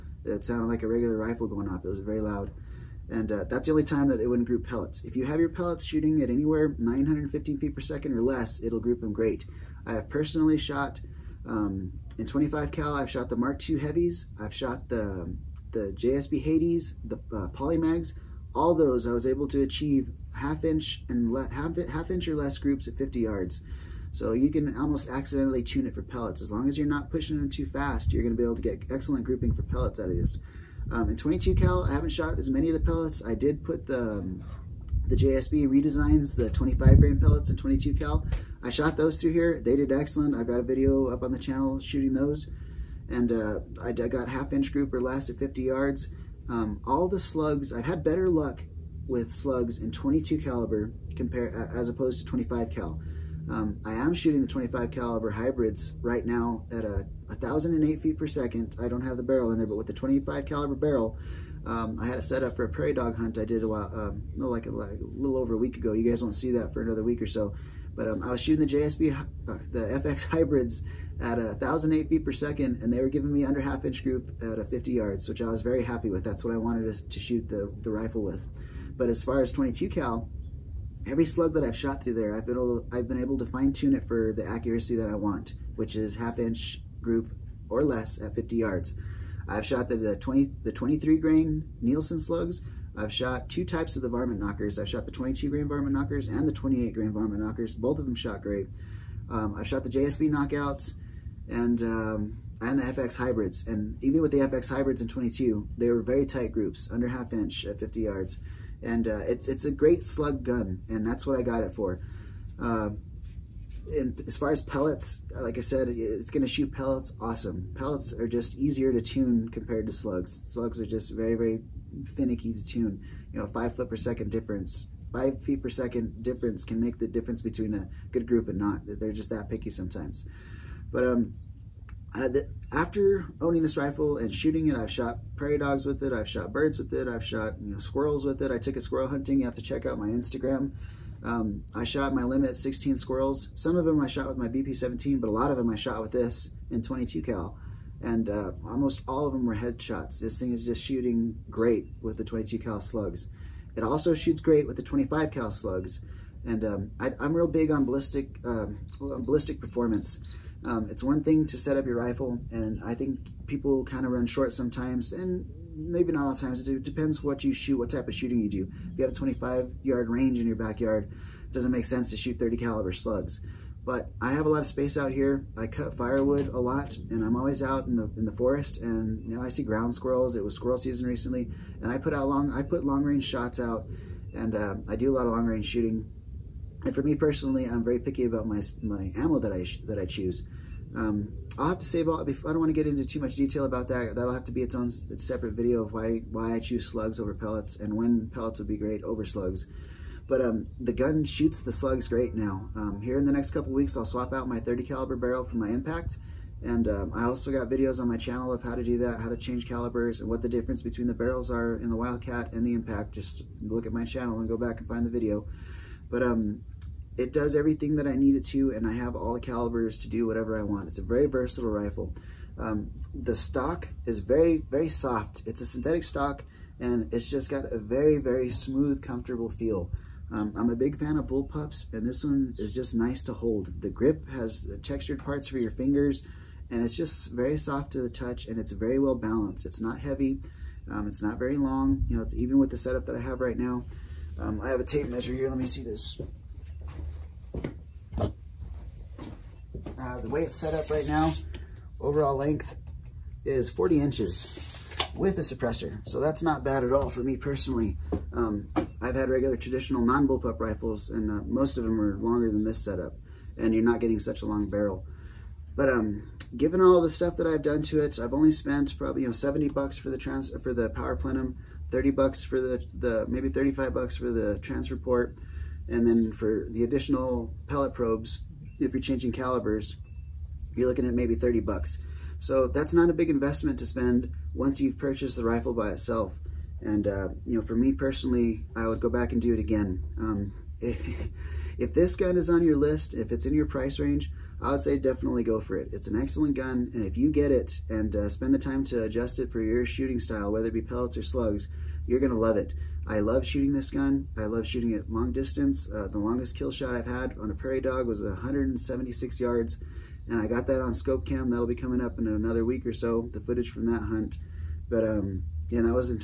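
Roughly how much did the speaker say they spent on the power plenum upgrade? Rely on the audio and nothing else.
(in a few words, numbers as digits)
$70.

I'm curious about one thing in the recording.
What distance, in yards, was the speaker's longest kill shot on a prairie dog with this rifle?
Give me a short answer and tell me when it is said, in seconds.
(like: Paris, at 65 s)
176 yards, at 308 s.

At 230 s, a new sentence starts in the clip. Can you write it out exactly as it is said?
Um, I'm a big fan of bull pups, and this one is just nice to hold.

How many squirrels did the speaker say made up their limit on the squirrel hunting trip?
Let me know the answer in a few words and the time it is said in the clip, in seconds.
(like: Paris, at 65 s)
16, at 142 s.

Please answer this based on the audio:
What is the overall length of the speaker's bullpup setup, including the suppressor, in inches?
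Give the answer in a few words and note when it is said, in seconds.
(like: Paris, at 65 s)
40 inches, at 253 s.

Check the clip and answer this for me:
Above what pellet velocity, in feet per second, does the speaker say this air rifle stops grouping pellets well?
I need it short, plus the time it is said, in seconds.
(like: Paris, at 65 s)
915, at 6 s.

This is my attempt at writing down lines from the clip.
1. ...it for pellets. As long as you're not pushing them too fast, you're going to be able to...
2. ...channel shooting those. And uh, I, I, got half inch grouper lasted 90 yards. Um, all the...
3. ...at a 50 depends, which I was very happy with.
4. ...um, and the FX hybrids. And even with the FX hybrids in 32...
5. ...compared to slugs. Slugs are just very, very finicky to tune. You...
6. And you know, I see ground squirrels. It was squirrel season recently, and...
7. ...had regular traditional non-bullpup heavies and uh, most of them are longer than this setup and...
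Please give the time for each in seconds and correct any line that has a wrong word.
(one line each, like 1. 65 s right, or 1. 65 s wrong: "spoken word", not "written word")
1. 25 s right
2. 41 s wrong: "50", not "90"
3. 74 s wrong: "yards", not "depends"
4. 101 s wrong: "22", not "32"
5. 119 s right
6. 178 s right
7. 259 s wrong: "rifles", not "heavies".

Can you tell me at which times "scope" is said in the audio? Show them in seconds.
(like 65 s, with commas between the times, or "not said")
310 s.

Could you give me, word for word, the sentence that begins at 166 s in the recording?
It depends what you shoot, what type of shooting you do.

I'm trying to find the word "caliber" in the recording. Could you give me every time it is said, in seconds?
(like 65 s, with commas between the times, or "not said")
50 s, 54 s, 60 s, 172 s, 204 s, 209 s, 219 s, 279 s.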